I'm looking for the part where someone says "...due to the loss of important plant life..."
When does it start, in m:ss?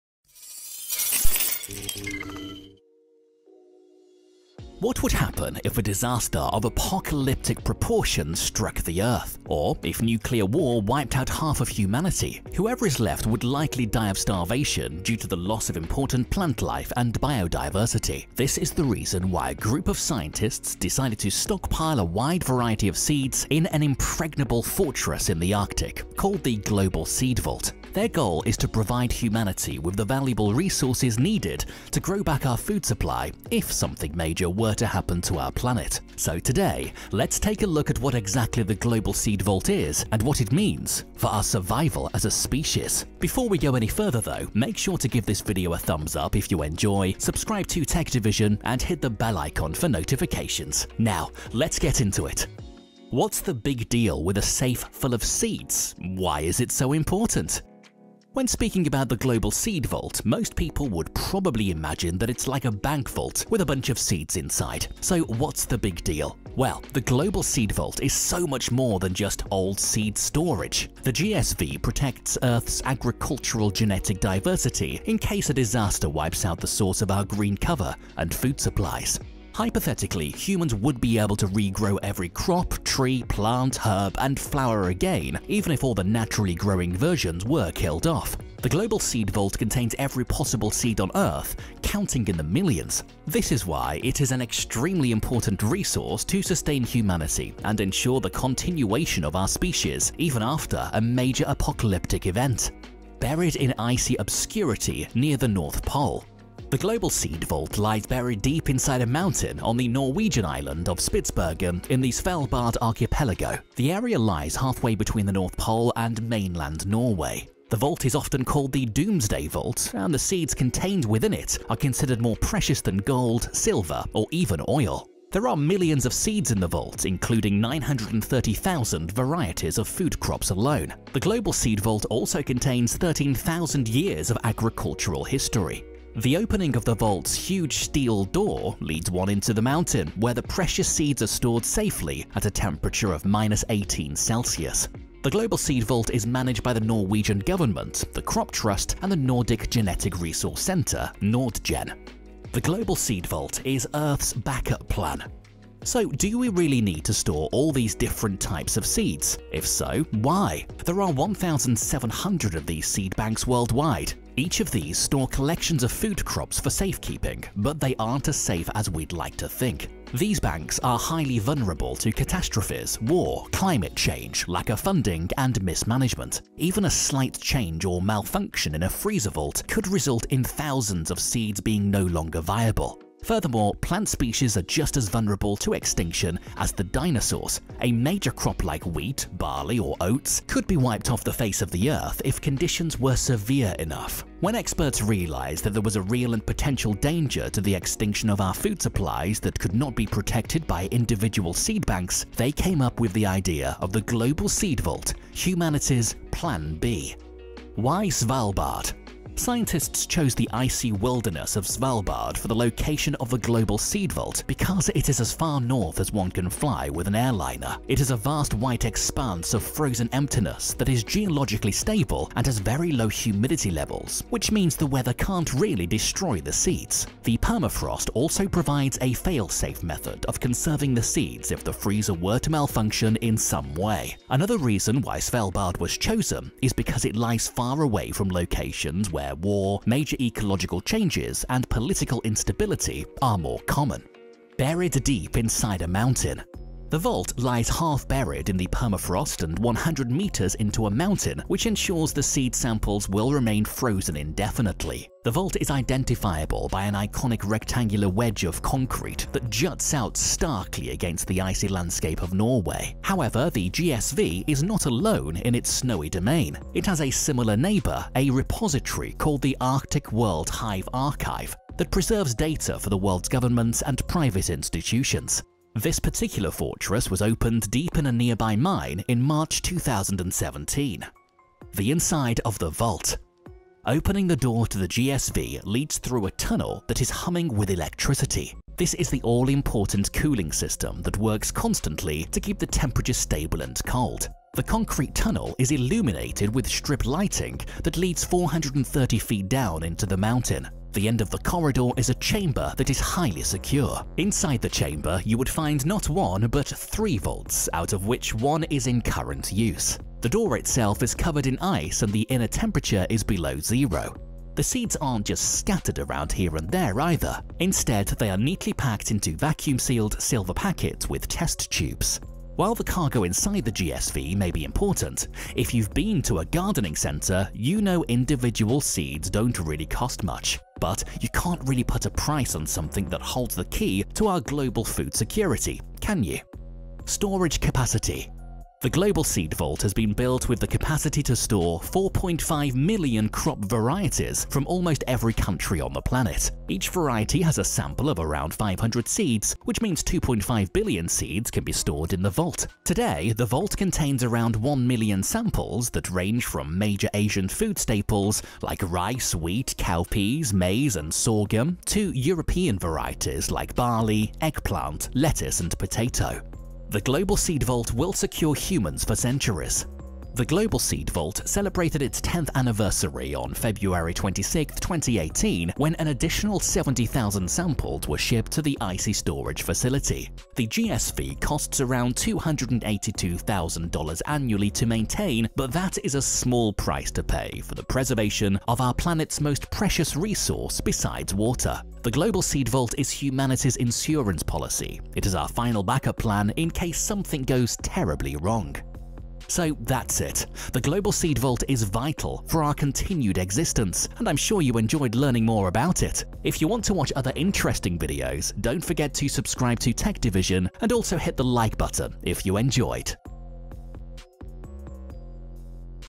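0:15.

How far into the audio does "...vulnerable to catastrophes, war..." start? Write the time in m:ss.
2:51.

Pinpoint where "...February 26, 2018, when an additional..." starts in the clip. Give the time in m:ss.
6:13.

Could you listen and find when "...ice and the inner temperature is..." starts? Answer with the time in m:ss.
5:11.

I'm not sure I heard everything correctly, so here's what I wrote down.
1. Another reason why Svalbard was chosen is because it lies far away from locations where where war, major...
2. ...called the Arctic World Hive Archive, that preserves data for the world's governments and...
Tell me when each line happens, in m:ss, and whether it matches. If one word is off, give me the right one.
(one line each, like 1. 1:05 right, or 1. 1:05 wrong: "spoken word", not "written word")
1. 3:54 right
2. 4:29 right.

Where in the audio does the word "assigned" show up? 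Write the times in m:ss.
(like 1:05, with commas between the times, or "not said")
not said.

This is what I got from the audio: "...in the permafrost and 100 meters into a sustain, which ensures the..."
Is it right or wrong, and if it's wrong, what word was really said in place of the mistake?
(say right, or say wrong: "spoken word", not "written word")
wrong: "mountain", not "sustain".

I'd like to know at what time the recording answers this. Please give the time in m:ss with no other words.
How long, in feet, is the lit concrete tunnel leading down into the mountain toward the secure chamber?
4:58.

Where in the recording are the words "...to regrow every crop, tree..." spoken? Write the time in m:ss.
1:21.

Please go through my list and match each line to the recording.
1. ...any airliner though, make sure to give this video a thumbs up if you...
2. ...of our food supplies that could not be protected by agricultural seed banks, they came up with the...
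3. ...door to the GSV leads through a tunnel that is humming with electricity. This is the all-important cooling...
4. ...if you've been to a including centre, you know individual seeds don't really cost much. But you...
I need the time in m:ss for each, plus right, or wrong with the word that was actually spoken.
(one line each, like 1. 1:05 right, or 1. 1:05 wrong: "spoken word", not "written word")
1. 0:43 wrong: "further", not "airliner"
2. 3:18 wrong: "individual", not "agricultural"
3. 4:44 right
4. 5:25 wrong: "gardening", not "including".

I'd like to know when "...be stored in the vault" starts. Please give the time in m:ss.
5:51.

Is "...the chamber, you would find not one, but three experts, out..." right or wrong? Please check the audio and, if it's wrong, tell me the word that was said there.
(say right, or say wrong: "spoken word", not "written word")
wrong: "vaults", not "experts".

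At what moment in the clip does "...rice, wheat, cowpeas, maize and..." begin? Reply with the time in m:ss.
5:58.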